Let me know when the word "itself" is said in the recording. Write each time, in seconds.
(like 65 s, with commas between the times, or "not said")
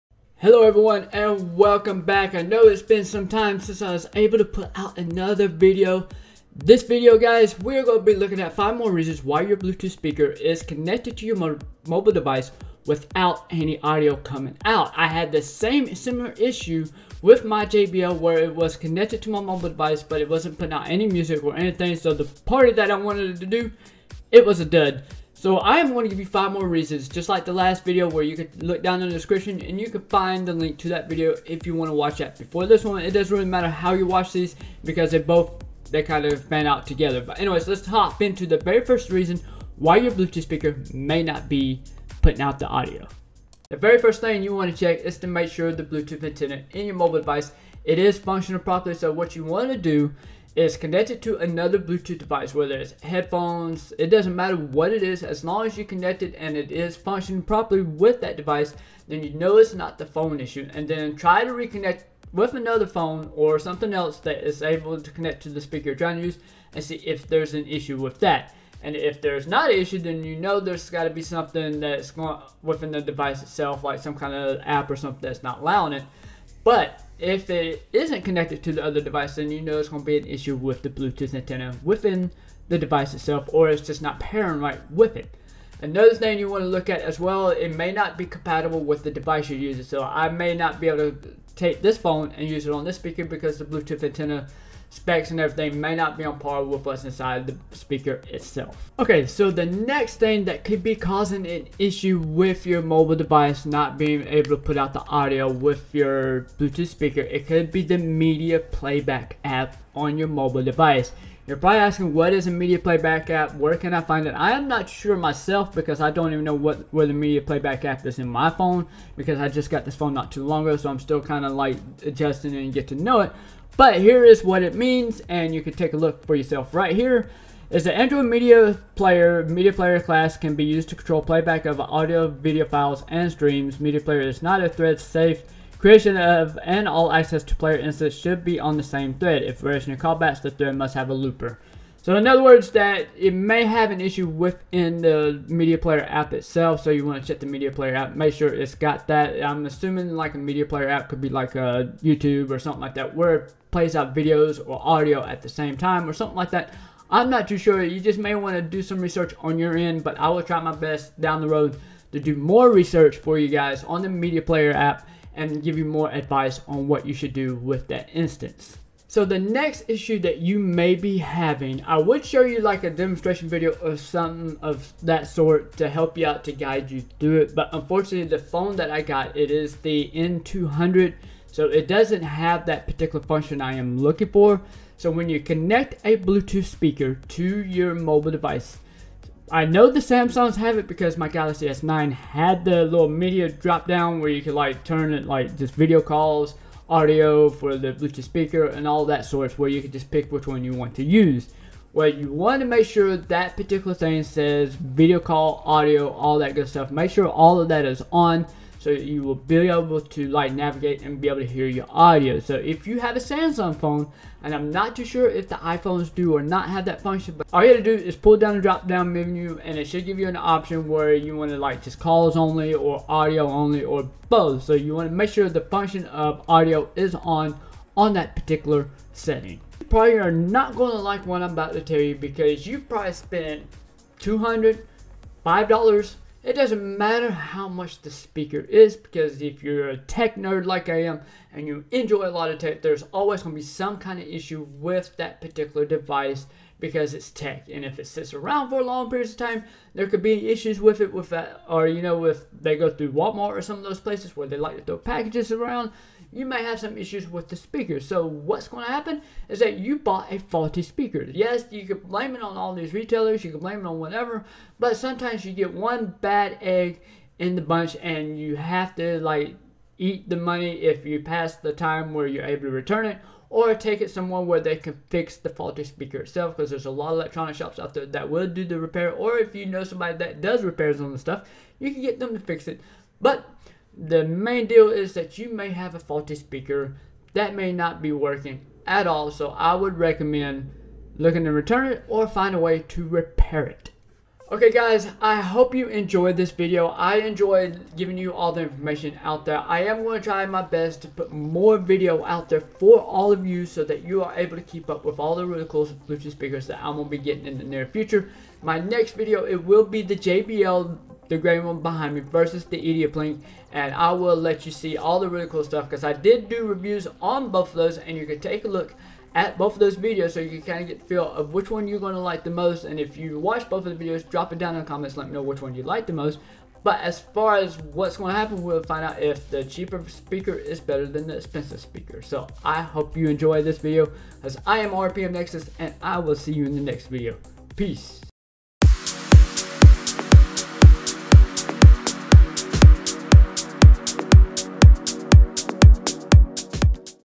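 73 s, 83 s, 98 s, 146 s, 276 s.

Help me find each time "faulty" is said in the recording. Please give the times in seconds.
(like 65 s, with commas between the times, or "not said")
260 s, 275 s, 285 s.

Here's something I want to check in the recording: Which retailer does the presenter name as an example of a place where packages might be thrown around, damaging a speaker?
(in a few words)
Walmart.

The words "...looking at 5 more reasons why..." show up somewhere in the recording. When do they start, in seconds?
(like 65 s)
8 s.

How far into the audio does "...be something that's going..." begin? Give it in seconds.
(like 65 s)
71 s.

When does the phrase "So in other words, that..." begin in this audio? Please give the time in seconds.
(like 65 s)
142 s.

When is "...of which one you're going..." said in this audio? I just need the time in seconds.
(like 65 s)
321 s.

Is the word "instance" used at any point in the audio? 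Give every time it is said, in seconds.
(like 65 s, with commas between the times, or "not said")
137 s, 168 s.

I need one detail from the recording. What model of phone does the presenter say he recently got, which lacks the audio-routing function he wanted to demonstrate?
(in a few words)
N200.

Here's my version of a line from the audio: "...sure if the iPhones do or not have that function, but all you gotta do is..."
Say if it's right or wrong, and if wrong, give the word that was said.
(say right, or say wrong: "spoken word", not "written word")
right.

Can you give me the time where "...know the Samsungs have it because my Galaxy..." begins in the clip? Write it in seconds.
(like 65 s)
189 s.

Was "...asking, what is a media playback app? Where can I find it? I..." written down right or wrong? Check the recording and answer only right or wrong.
right.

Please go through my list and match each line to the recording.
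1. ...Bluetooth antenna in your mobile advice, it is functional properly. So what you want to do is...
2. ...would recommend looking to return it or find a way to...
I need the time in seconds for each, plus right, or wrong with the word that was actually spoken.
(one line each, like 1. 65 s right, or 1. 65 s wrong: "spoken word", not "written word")
1. 45 s wrong: "device", not "advice"
2. 289 s right.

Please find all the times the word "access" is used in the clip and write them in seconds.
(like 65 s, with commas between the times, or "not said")
137 s.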